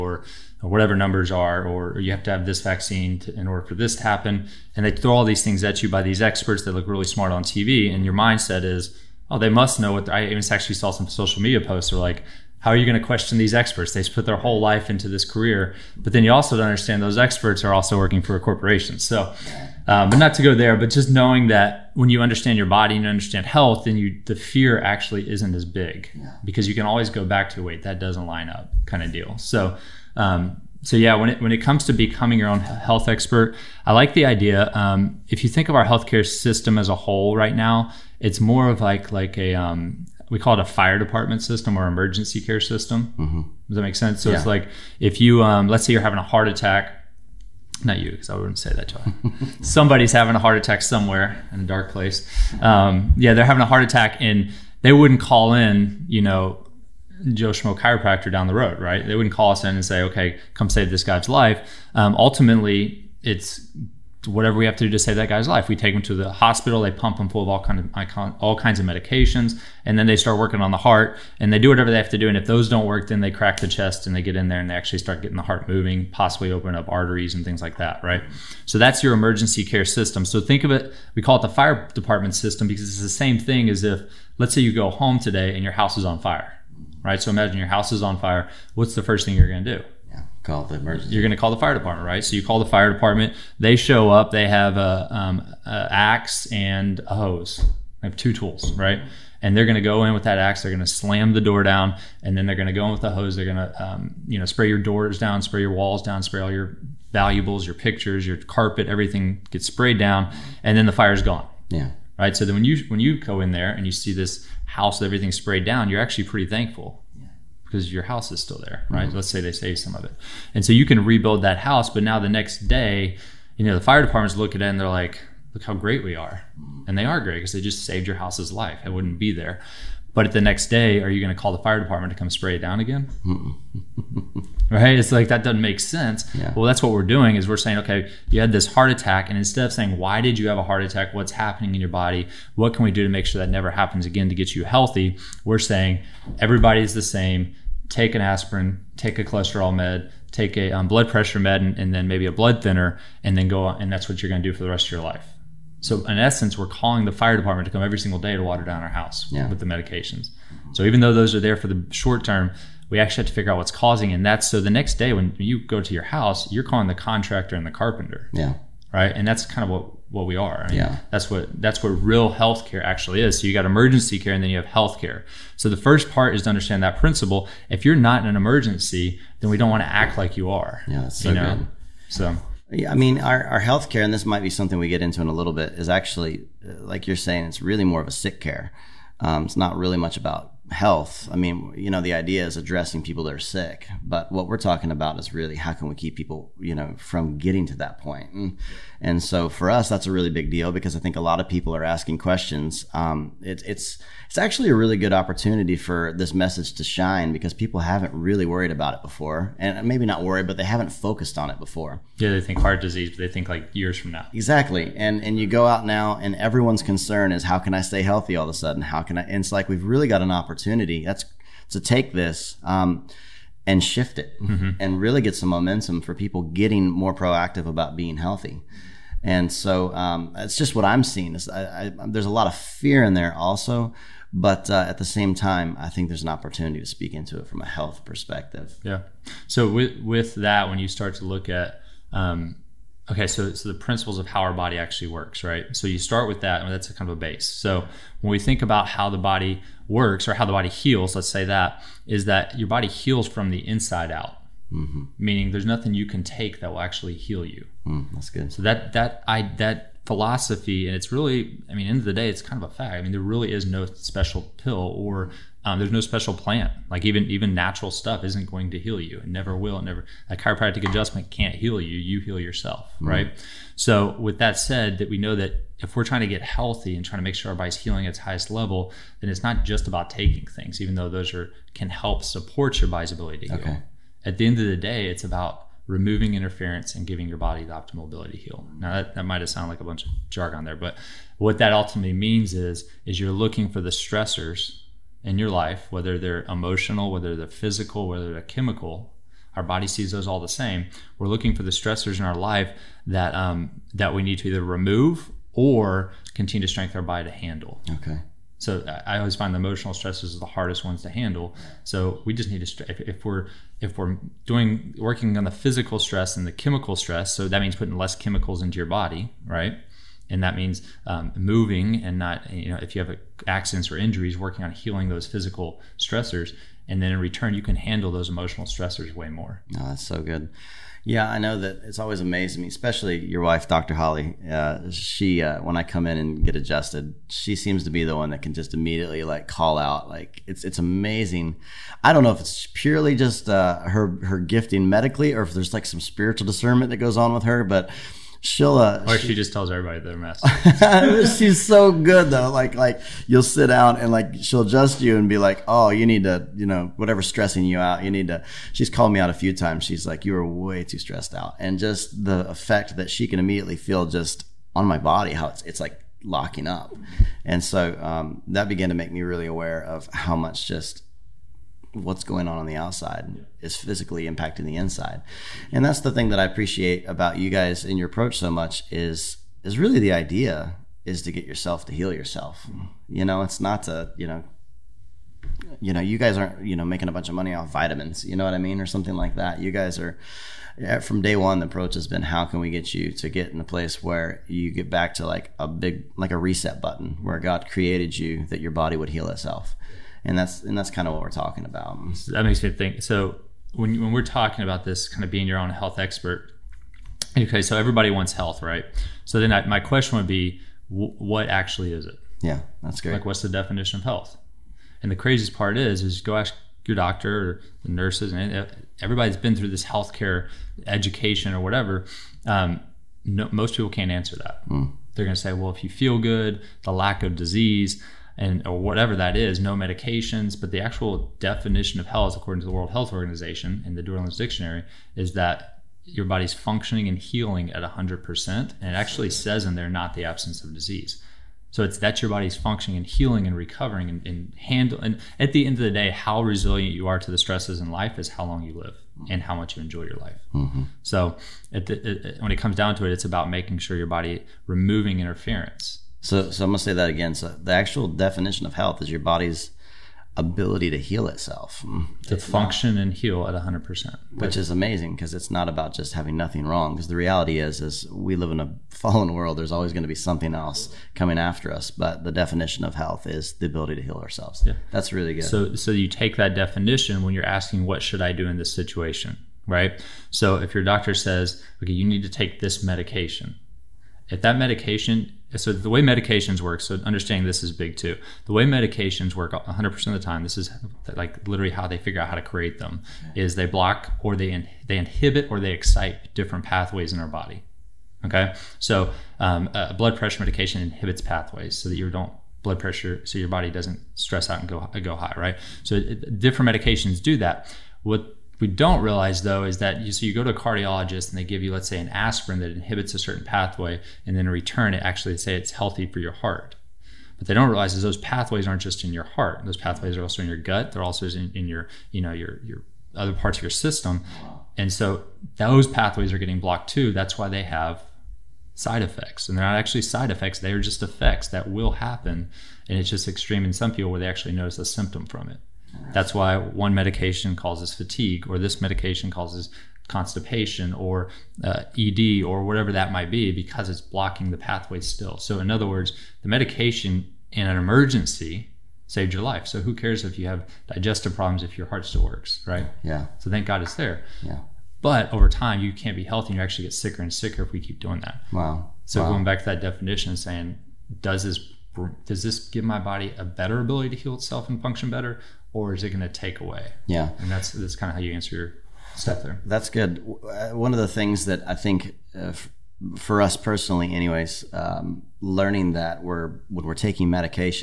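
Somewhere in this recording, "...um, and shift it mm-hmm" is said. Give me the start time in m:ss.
3:42.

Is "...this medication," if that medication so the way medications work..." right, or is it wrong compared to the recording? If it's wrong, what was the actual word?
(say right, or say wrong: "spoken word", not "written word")
right.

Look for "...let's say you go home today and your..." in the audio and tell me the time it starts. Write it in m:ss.
1:24.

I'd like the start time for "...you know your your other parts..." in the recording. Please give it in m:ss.
8:42.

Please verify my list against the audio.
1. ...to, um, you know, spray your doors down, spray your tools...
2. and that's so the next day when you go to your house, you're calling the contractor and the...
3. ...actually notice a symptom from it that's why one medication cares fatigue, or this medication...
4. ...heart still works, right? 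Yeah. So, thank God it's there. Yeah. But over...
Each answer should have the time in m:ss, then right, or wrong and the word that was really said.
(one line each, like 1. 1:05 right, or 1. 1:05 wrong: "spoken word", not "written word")
1. 1:43 wrong: "walls", not "tools"
2. 2:44 right
3. 8:54 wrong: "causes", not "cares"
4. 9:11 right.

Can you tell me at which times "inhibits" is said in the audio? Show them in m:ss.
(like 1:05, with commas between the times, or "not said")
8:14, 8:20, 8:32.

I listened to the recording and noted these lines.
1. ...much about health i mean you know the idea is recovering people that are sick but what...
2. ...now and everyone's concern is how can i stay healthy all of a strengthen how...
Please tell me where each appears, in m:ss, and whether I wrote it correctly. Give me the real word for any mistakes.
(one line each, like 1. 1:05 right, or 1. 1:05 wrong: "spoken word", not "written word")
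1. 3:09 wrong: "addressing", not "recovering"
2. 3:35 wrong: "sudden", not "strengthen".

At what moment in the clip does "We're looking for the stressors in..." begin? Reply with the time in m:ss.
5:01.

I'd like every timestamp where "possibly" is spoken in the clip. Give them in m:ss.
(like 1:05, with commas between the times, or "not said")
1:16.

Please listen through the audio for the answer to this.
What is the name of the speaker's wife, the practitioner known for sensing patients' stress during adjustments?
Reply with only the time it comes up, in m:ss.
5:33.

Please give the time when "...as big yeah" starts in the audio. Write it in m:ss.
0:25.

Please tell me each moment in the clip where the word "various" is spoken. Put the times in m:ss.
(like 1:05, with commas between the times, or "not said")
not said.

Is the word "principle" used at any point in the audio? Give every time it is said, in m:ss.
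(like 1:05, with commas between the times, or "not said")
2:56, 4:03.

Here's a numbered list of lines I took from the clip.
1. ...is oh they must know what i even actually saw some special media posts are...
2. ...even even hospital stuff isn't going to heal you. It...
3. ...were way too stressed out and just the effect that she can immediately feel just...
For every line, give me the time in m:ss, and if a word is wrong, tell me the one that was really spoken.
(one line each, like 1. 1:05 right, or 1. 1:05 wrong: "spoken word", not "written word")
1. 0:08 wrong: "social", not "special"
2. 4:27 wrong: "natural", not "hospital"
3. 6:00 right.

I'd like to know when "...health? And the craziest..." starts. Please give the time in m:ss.
6:54.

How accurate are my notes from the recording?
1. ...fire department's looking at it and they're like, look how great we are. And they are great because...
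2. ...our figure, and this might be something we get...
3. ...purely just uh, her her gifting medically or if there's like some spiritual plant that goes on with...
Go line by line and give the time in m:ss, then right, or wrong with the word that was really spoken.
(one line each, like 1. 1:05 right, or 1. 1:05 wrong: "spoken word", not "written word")
1. 2:03 right
2. 3:03 wrong: "healthcare", not "figure"
3. 5:42 wrong: "discernment", not "plant".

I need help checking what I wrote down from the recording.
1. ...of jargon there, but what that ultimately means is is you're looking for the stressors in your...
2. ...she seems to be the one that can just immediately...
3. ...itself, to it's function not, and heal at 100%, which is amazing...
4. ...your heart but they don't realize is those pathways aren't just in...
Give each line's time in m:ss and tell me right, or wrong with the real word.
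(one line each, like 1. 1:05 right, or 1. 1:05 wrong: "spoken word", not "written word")
1. 4:50 right
2. 5:37 right
3. 7:41 right
4. 8:36 right.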